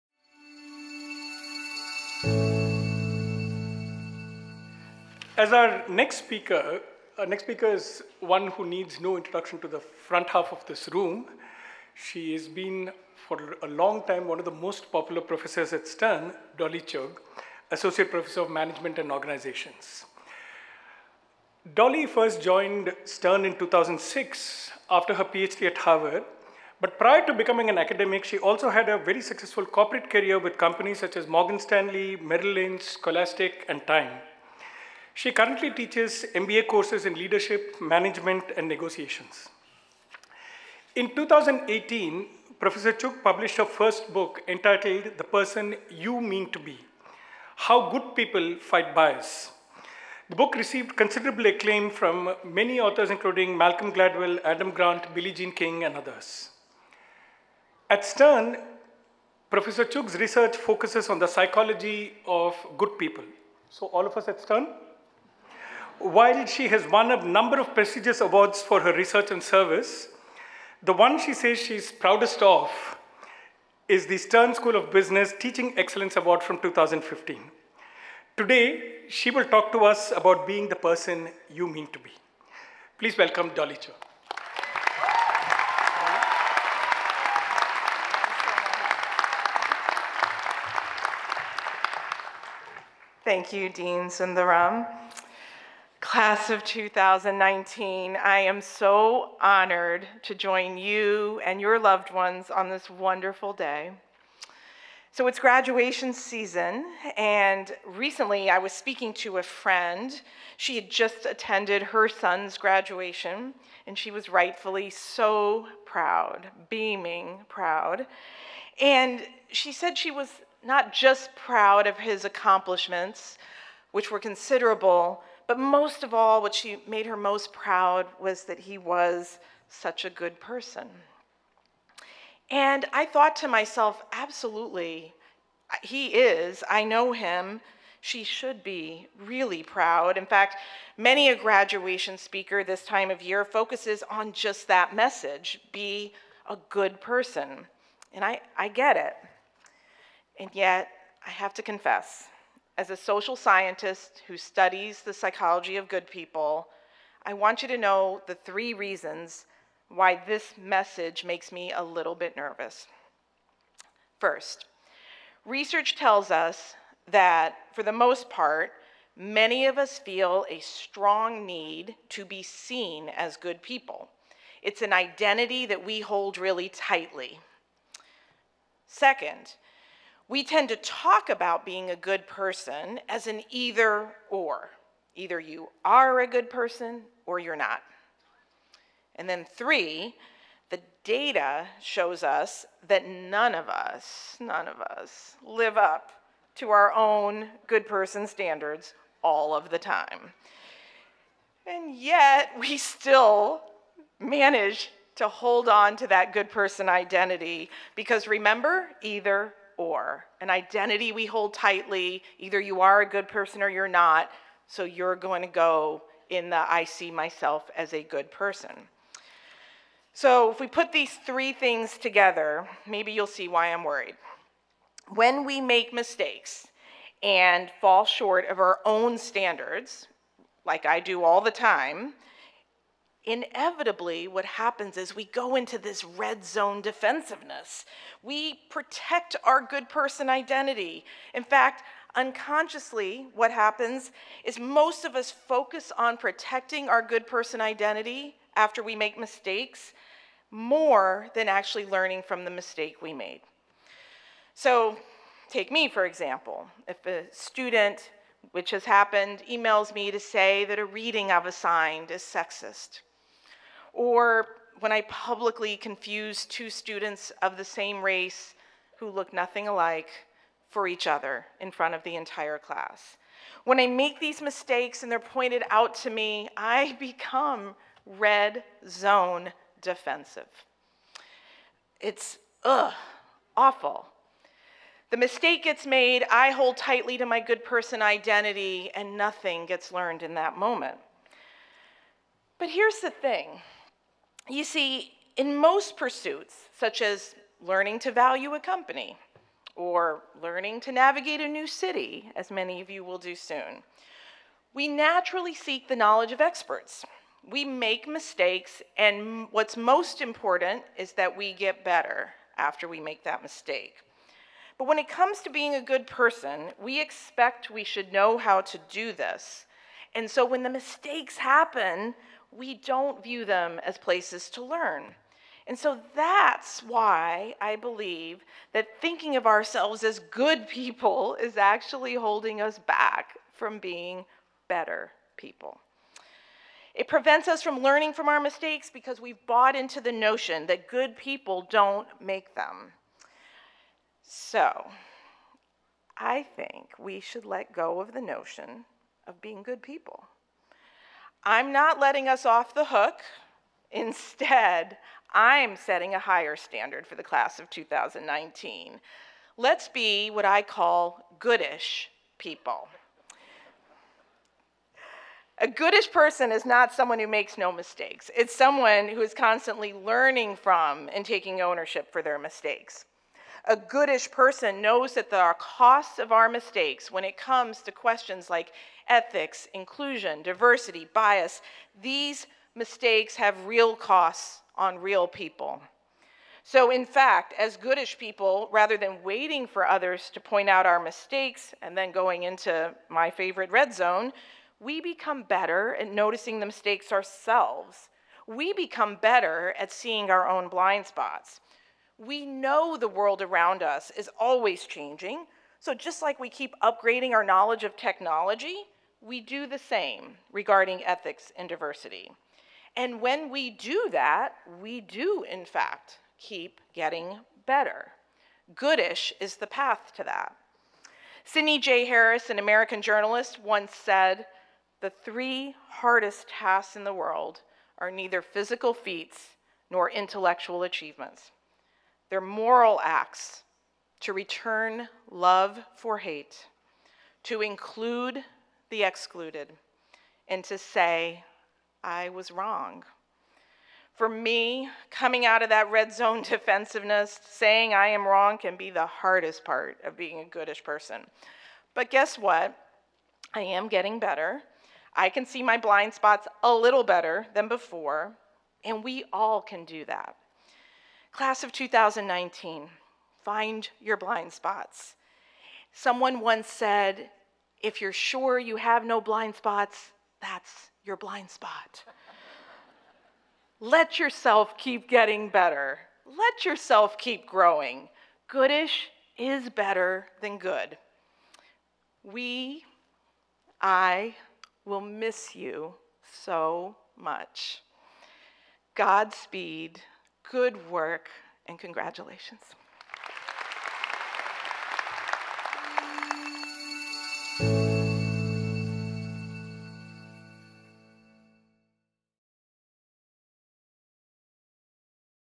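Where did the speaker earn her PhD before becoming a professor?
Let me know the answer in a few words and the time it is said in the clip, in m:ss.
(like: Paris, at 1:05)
Harvard, at 0:25.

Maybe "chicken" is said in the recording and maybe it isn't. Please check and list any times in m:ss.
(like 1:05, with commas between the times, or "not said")
not said.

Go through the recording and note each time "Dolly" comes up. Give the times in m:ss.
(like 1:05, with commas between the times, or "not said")
0:16, 0:21, 1:23.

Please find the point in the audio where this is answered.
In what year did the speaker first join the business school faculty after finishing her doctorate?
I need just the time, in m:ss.
0:23.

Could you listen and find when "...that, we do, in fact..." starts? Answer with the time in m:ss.
6:54.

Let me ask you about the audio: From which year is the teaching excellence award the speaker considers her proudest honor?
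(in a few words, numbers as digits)
2015.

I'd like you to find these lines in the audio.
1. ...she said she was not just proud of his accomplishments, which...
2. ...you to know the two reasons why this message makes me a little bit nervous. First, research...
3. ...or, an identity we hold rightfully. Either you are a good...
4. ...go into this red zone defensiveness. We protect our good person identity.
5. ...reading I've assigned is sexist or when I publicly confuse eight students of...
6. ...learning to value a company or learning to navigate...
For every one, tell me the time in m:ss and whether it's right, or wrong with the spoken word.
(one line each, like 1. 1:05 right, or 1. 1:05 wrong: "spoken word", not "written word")
1. 1:59 right
2. 2:37 wrong: "three", not "two"
3. 3:29 wrong: "tightly", not "rightfully"
4. 3:55 right
5. 4:20 wrong: "two", not "eight"
6. 4:57 right.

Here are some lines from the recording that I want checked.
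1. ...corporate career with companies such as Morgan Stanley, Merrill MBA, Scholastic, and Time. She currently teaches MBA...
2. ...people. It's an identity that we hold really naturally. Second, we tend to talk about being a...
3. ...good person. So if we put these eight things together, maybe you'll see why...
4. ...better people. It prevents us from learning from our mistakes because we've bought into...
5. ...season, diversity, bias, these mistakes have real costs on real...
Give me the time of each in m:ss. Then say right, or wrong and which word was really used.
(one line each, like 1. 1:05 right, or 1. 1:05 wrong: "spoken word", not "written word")
1. 0:29 wrong: "Lynch", not "MBA"
2. 2:53 wrong: "tightly", not "naturally"
3. 3:38 wrong: "three", not "eight"
4. 5:34 right
5. 6:19 wrong: "inclusion", not "season".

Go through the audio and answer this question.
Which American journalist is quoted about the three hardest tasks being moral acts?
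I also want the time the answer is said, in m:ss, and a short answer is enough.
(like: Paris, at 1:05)
Sidney J. Harris, at 7:01.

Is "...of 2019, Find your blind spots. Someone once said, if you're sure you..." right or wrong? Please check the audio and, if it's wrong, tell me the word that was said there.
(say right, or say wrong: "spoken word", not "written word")
right.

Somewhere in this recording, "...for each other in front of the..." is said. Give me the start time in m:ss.
4:30.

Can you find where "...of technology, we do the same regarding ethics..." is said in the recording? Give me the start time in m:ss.
6:47.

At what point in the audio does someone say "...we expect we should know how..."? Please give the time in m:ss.
5:16.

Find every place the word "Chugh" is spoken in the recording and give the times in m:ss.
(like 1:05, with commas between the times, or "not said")
0:16, 0:42, 0:59, 1:23.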